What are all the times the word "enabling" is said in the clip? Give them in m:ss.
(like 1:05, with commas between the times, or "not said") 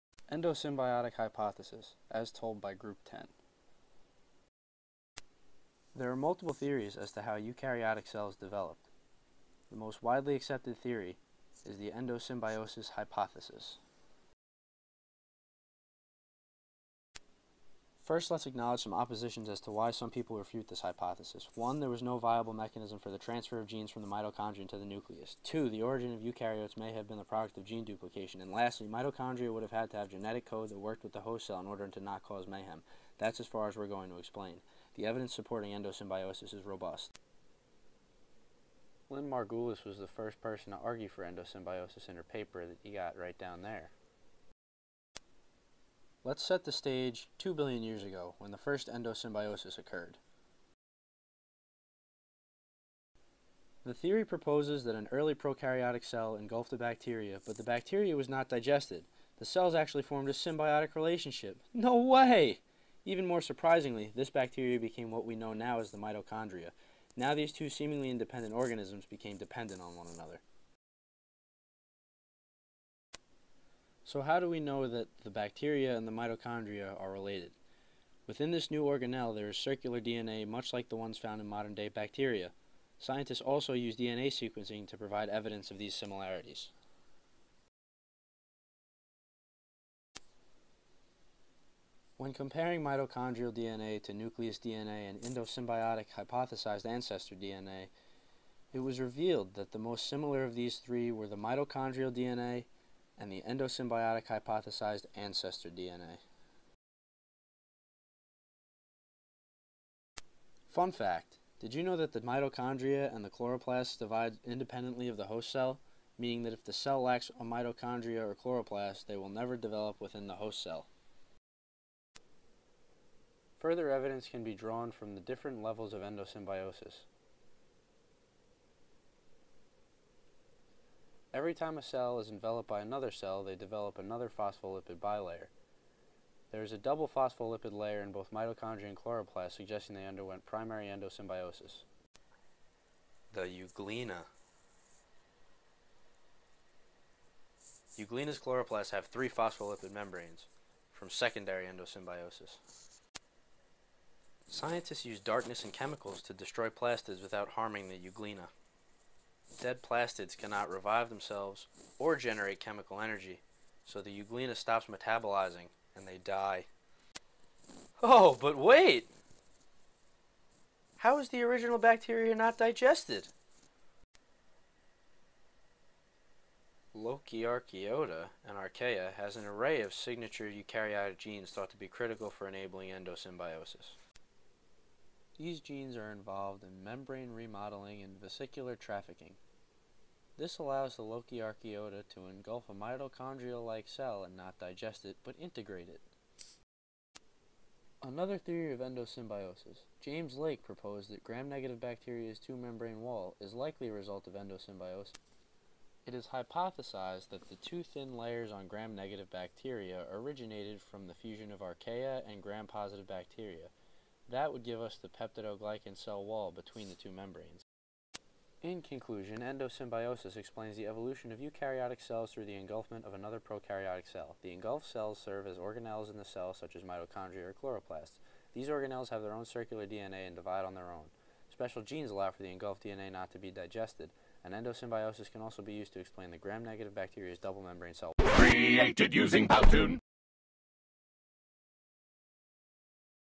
3:02.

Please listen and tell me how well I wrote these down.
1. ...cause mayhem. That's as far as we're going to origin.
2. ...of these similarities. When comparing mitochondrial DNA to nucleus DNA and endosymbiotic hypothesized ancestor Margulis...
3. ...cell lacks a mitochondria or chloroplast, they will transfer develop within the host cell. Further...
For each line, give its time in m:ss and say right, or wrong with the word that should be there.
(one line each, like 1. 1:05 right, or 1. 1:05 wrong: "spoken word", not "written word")
1. 0:32 wrong: "explain", not "origin"
2. 1:25 wrong: "DNA", not "Margulis"
3. 1:56 wrong: "never", not "transfer".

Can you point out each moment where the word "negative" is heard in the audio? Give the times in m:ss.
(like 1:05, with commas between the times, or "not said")
3:21, 3:28, 3:56.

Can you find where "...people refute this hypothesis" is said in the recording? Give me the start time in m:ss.
0:20.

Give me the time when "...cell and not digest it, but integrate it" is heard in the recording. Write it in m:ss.
3:13.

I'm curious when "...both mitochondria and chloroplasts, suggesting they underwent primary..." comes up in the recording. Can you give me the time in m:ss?
2:18.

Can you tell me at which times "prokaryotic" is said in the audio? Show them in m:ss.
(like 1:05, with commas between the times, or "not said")
0:55, 3:43.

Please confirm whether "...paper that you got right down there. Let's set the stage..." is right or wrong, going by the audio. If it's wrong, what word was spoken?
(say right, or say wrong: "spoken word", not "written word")
right.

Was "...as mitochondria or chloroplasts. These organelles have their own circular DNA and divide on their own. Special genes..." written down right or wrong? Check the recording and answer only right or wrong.
right.